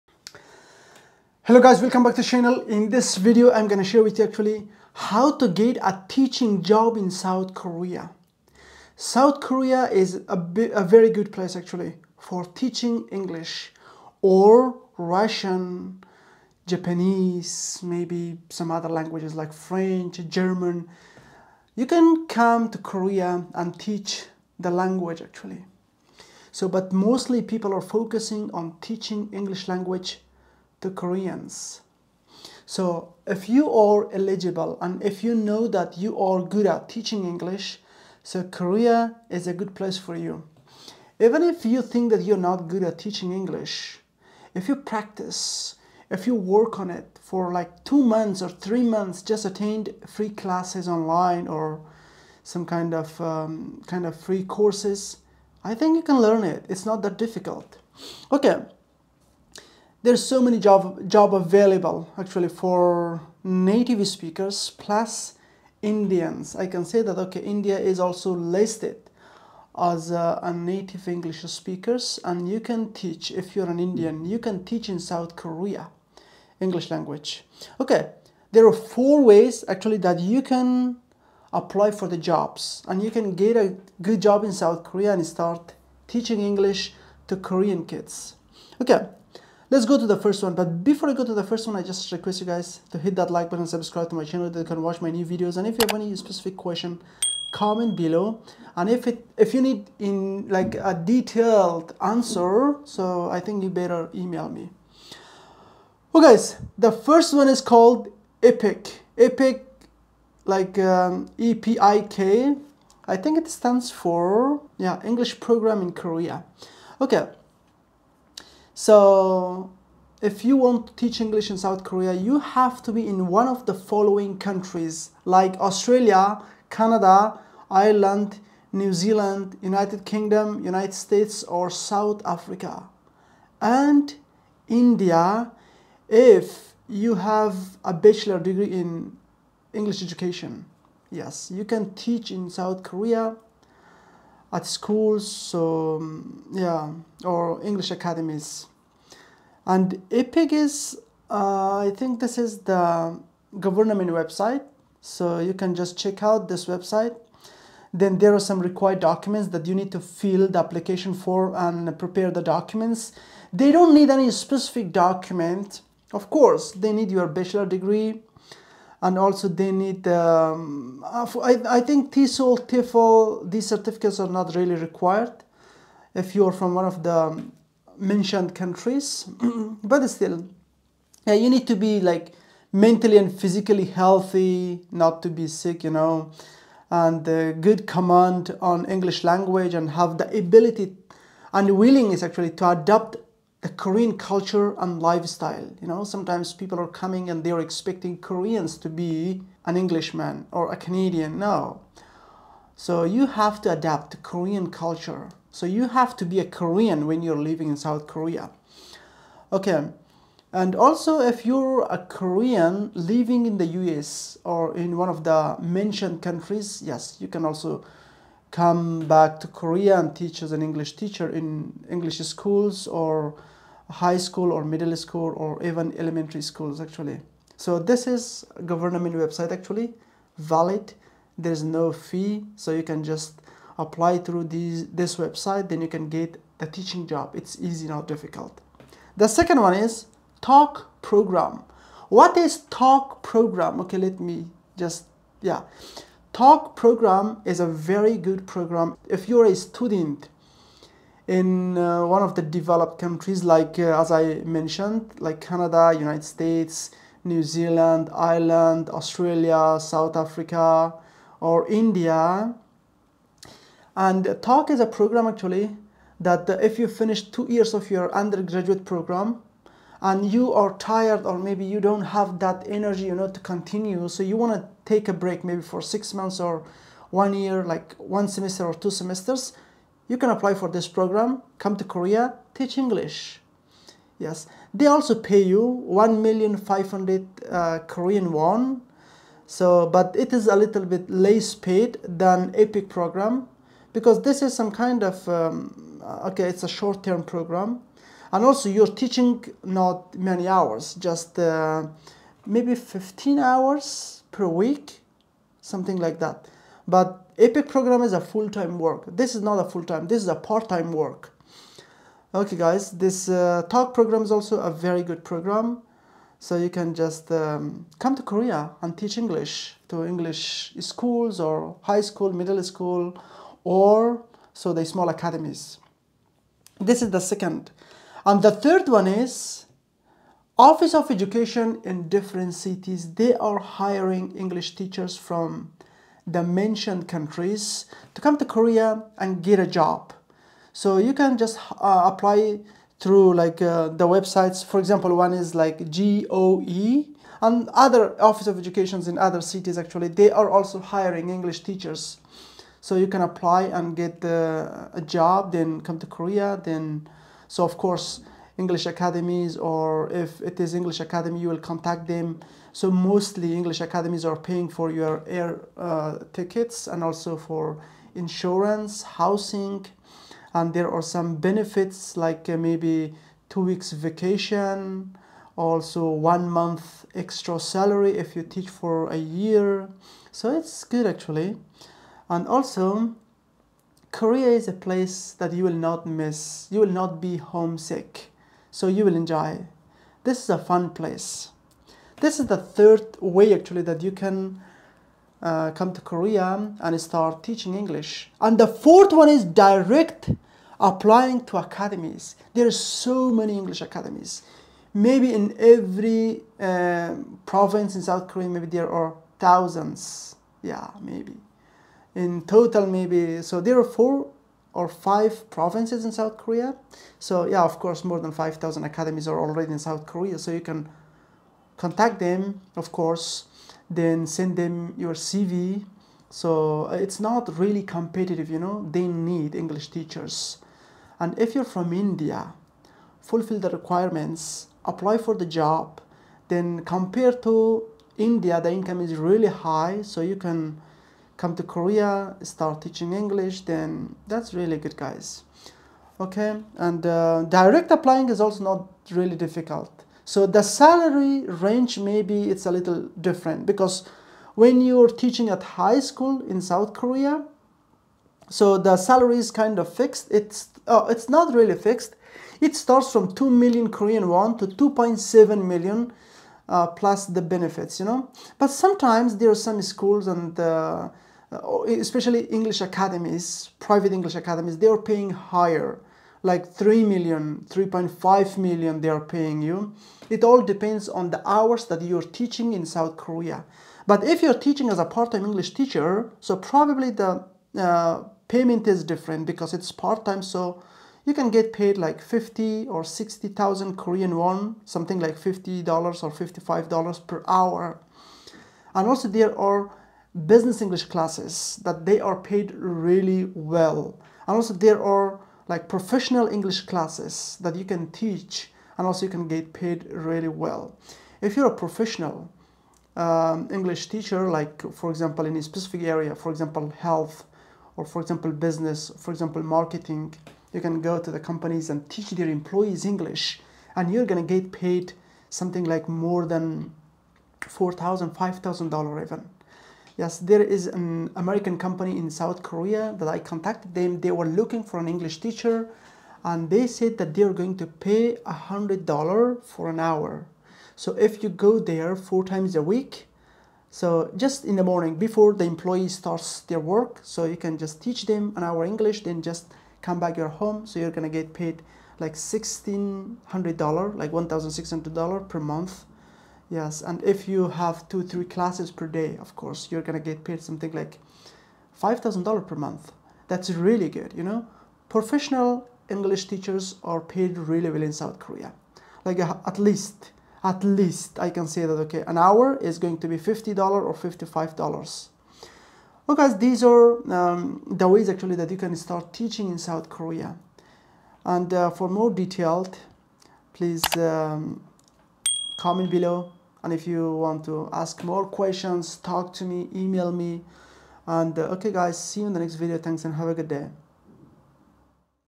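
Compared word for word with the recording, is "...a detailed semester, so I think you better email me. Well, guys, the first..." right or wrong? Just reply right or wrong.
wrong.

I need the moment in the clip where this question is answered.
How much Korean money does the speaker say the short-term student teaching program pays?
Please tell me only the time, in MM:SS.
04:45.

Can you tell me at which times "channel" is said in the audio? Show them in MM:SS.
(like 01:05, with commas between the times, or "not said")
00:02, 01:34.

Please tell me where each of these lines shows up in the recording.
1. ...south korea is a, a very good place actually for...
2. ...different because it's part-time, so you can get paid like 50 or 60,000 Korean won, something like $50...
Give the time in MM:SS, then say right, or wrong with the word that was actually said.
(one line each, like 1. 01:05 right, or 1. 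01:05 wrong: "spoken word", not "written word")
1. 00:08 right
2. 08:09 right.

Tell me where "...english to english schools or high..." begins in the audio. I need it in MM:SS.
05:19.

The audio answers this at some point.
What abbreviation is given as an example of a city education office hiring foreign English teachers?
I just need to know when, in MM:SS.
05:45.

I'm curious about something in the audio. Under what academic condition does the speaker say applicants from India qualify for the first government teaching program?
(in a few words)
bachelor degree in English education.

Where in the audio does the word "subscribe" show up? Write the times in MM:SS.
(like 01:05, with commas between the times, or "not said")
01:33.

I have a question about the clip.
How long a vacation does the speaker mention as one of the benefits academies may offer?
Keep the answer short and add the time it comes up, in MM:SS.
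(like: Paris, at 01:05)
two weeks, at 06:13.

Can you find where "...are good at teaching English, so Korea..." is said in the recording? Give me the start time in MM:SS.
00:36.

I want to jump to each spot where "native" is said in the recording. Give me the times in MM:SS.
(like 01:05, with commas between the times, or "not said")
01:03, 01:10.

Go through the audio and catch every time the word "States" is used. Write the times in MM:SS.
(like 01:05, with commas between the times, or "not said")
02:10, 04:16.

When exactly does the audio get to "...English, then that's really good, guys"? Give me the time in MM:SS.
07:23.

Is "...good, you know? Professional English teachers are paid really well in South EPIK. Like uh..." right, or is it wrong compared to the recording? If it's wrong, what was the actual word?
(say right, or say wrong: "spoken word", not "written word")
wrong: "Korea", not "EPIK".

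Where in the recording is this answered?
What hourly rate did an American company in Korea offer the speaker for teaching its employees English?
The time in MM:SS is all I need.
08:58.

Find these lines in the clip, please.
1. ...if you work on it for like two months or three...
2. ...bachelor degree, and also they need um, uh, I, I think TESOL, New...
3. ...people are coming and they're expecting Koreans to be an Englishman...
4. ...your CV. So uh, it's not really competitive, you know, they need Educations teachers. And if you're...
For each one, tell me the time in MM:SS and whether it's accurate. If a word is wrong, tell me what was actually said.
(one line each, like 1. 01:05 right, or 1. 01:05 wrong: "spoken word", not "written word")
1. 00:46 right
2. 02:47 wrong: "TEFL", not "New"
3. 03:16 right
4. 07:04 wrong: "English", not "Educations".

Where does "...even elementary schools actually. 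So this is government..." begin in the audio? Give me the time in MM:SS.
03:45.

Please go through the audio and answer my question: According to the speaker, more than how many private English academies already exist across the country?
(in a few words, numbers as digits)
5,000.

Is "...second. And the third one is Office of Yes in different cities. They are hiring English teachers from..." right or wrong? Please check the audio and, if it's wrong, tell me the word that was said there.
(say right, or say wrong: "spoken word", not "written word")
wrong: "Education", not "Yes".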